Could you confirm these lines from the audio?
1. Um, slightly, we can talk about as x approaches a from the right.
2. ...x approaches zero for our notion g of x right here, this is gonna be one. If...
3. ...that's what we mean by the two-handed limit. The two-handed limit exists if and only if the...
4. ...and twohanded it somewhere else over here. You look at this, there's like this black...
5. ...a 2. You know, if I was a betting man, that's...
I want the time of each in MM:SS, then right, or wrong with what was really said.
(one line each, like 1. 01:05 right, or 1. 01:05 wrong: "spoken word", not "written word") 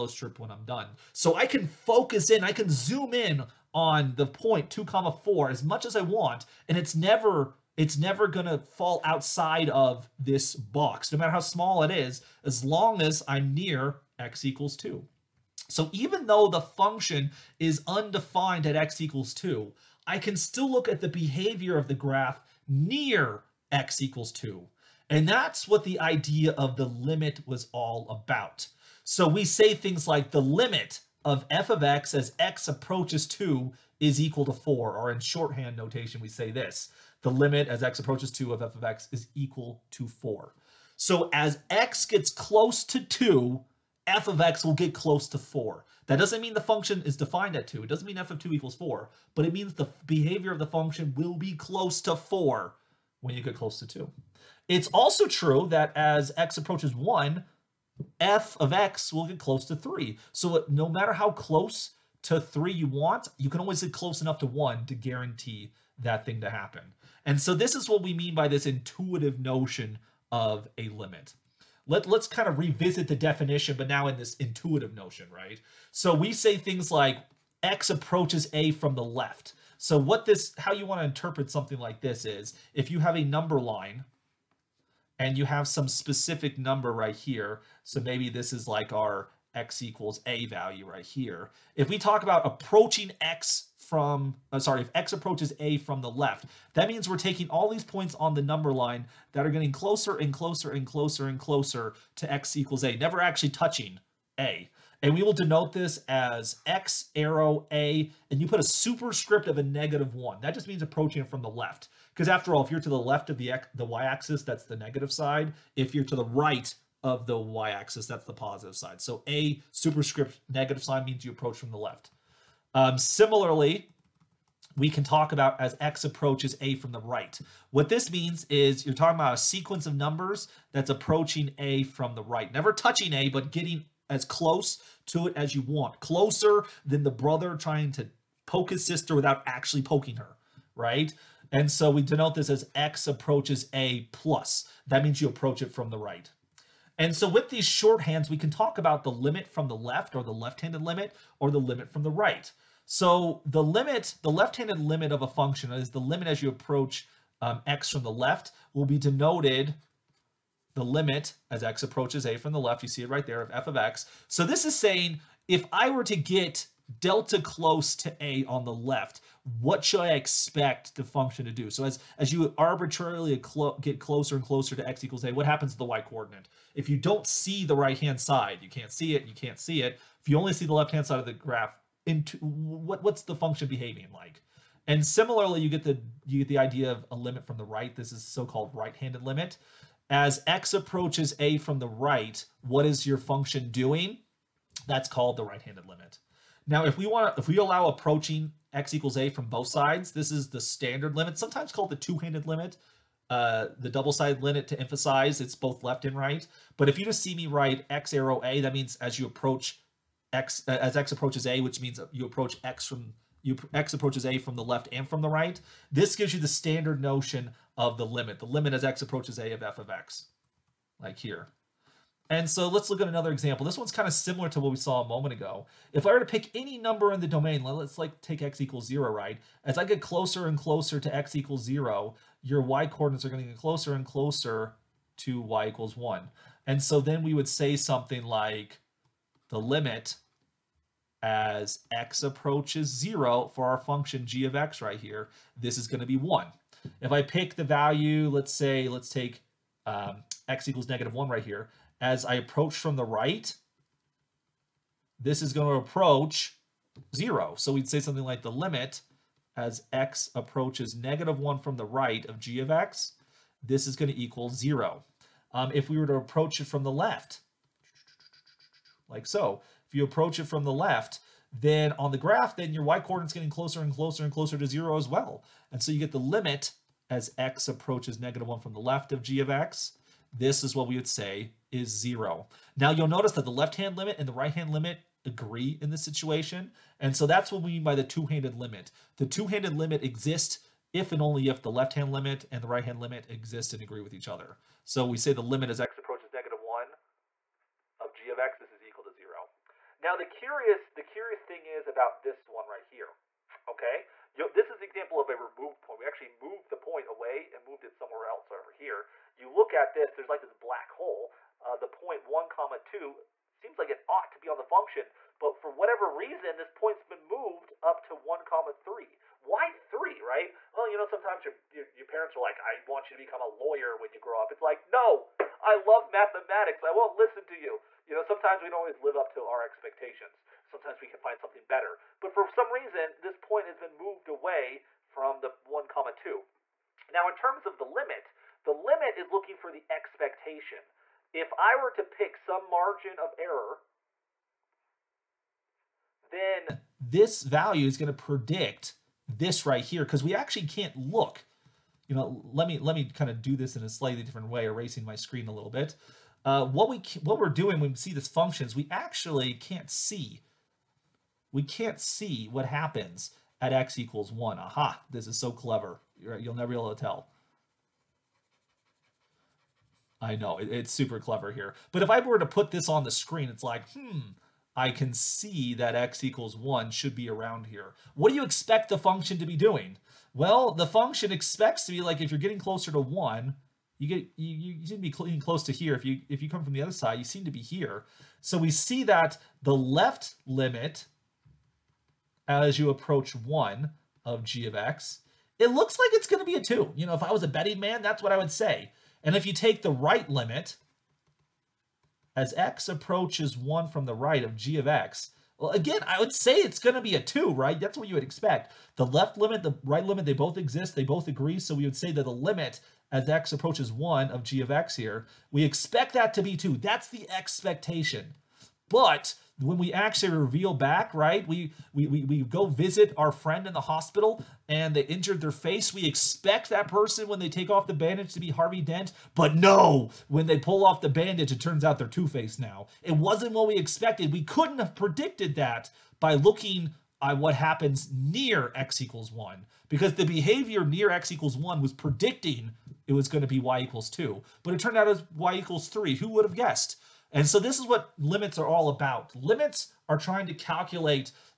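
1. 02:02 wrong: "similarly", not "slightly"
2. 04:01 wrong: "function", not "notion"
3. 04:47 right
4. 05:07 wrong: "moved", not "twohanded"
5. 06:36 right.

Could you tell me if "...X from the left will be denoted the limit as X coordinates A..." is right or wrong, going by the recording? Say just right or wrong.
wrong.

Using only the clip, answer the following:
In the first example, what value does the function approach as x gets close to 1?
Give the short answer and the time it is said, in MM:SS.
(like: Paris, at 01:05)
3, at 00:58.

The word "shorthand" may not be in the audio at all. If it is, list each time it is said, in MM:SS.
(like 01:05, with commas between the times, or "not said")
00:35, 02:27.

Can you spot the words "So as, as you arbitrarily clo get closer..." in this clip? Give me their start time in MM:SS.
02:51.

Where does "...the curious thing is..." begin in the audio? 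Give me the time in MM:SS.
05:00.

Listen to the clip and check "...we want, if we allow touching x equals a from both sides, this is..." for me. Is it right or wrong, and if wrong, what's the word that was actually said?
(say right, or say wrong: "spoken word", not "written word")
wrong: "approaching", not "touching".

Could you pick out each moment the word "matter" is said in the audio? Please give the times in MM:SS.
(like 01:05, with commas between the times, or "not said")
00:11, 01:00.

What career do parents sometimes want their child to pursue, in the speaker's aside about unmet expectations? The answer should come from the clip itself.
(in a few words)
lawyer.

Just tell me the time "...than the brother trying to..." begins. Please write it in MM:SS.
02:16.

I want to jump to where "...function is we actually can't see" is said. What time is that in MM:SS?
05:58.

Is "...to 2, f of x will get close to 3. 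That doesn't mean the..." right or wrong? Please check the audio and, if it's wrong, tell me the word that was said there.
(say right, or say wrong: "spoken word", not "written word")
wrong: "4", not "3".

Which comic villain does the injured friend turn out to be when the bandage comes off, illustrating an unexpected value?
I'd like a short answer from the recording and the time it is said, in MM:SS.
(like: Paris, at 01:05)
Two Face, at 07:12.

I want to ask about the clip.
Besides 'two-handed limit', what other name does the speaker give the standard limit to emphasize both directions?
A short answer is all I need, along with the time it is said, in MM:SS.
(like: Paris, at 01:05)
double-sided limit, at 03:23.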